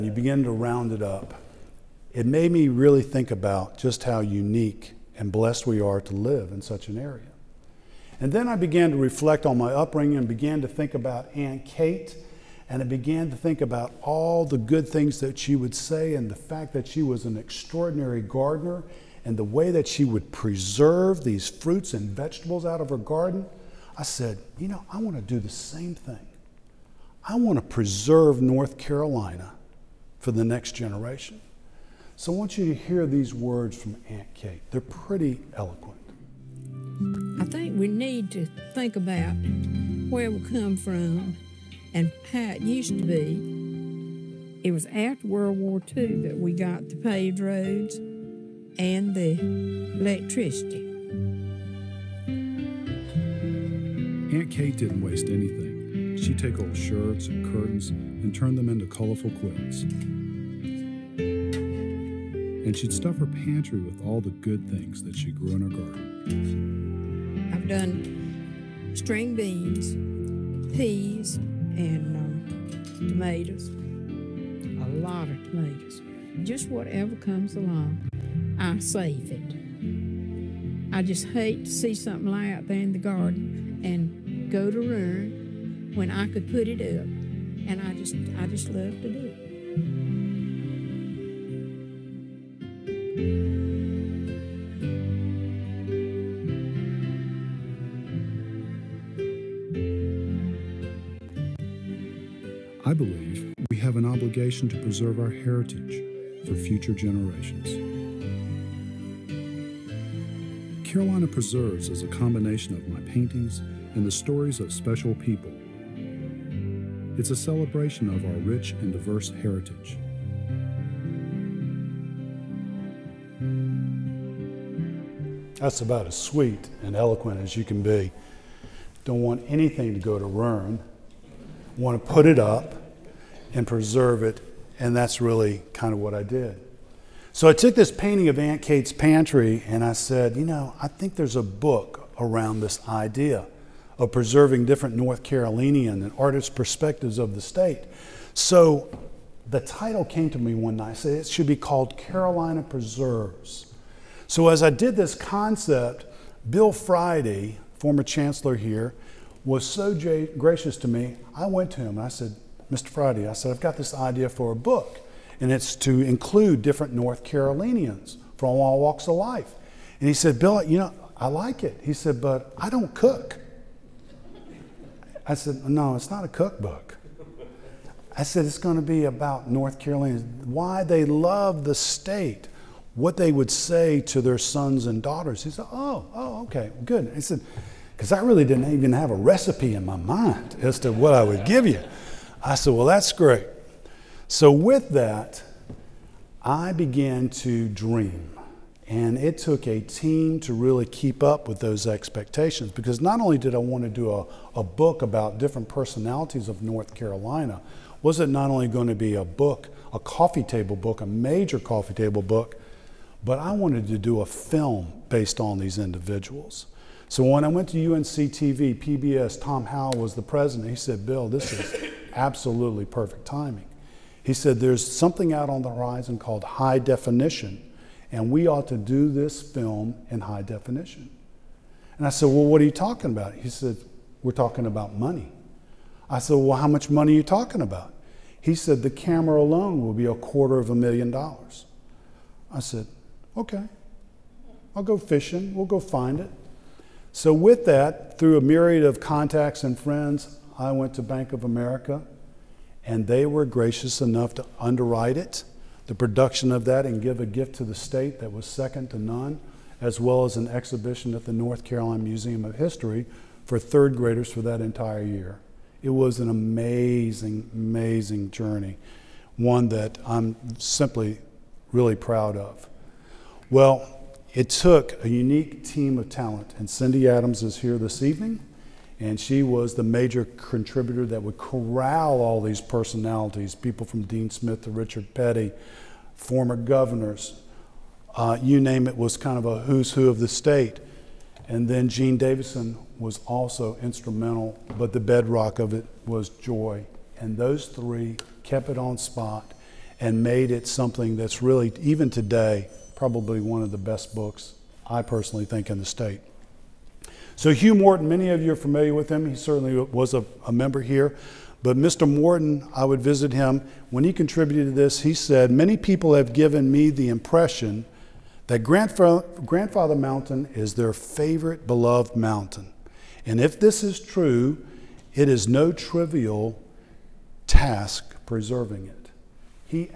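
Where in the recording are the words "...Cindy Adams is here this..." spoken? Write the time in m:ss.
4:36.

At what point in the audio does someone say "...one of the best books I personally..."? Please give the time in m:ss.
5:03.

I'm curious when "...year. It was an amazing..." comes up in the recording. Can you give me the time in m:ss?
4:25.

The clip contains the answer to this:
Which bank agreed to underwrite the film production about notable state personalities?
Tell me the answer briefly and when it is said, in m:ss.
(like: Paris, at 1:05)
Bank of America, at 4:11.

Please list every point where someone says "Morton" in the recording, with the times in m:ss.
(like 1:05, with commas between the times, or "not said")
5:07, 5:12.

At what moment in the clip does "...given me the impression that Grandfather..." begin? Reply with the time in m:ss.
5:16.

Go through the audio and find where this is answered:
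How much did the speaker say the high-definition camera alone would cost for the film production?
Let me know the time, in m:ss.
4:00.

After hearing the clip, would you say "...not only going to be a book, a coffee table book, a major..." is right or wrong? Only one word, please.
right.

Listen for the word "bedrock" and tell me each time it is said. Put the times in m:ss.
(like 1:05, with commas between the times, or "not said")
4:55.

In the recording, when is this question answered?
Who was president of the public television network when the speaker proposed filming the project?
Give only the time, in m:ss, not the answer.
3:39.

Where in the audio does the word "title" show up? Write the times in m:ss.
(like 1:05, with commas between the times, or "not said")
2:29.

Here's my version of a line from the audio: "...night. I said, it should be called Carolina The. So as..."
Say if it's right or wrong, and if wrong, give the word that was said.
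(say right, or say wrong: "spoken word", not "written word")
wrong: "Preserves", not "The".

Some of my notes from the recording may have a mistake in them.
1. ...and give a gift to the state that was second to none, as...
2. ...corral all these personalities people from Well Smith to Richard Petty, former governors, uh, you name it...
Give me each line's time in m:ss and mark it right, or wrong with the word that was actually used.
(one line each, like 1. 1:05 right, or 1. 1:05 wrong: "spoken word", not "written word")
1. 4:16 right
2. 4:41 wrong: "Dean", not "Well".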